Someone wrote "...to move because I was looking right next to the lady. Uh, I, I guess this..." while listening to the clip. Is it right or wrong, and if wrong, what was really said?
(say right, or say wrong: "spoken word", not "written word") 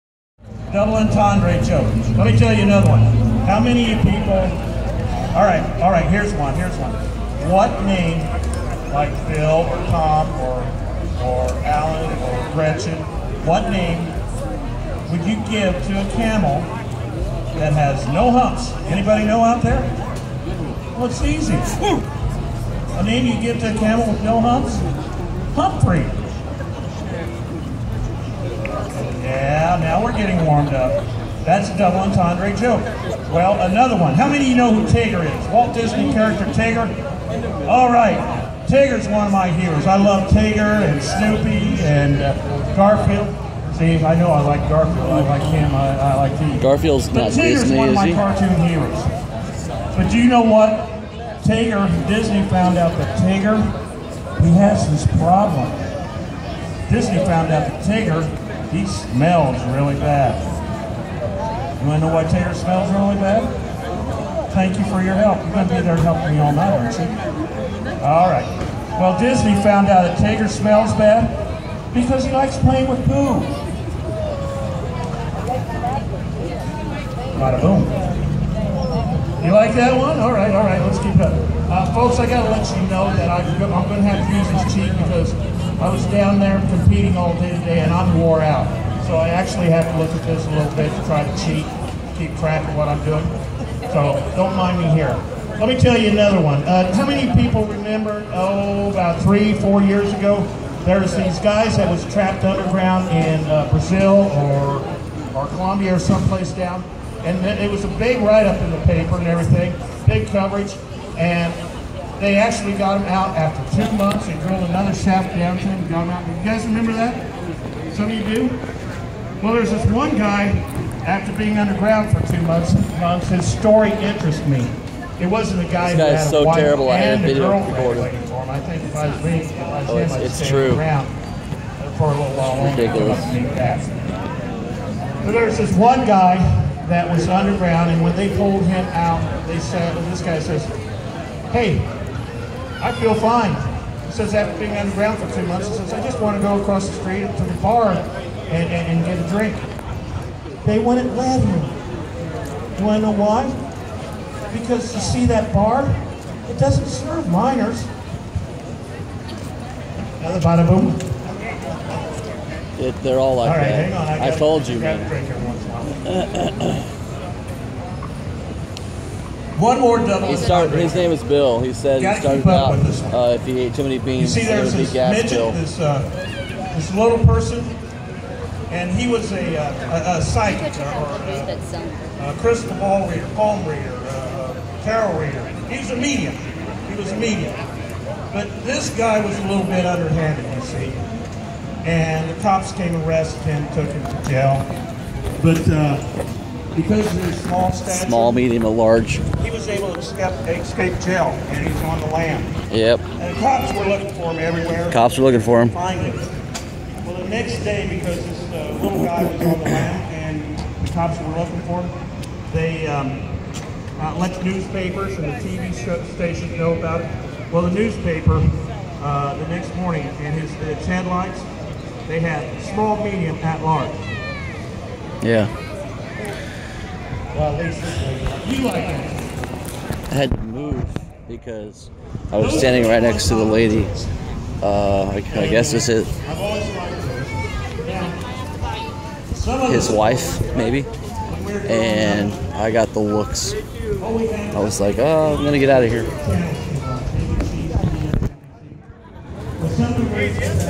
wrong: "standing", not "looking".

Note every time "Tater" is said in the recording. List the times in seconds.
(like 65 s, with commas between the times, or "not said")
62 s, 70 s.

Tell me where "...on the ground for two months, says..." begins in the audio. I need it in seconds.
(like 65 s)
144 s.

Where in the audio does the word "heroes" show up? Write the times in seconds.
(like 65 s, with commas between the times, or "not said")
39 s, 48 s.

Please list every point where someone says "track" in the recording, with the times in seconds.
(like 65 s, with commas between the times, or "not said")
92 s.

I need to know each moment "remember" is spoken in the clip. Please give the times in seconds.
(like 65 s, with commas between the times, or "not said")
97 s, 116 s.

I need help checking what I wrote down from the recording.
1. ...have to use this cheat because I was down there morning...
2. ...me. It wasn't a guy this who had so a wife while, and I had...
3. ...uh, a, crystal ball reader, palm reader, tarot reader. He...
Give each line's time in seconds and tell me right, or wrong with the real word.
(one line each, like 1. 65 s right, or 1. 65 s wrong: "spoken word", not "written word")
1. 84 s wrong: "competing", not "morning"
2. 124 s wrong: "terrible", not "while"
3. 181 s right.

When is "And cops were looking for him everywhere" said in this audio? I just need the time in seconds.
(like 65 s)
203 s.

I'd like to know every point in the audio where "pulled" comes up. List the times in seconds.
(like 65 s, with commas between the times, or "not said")
138 s.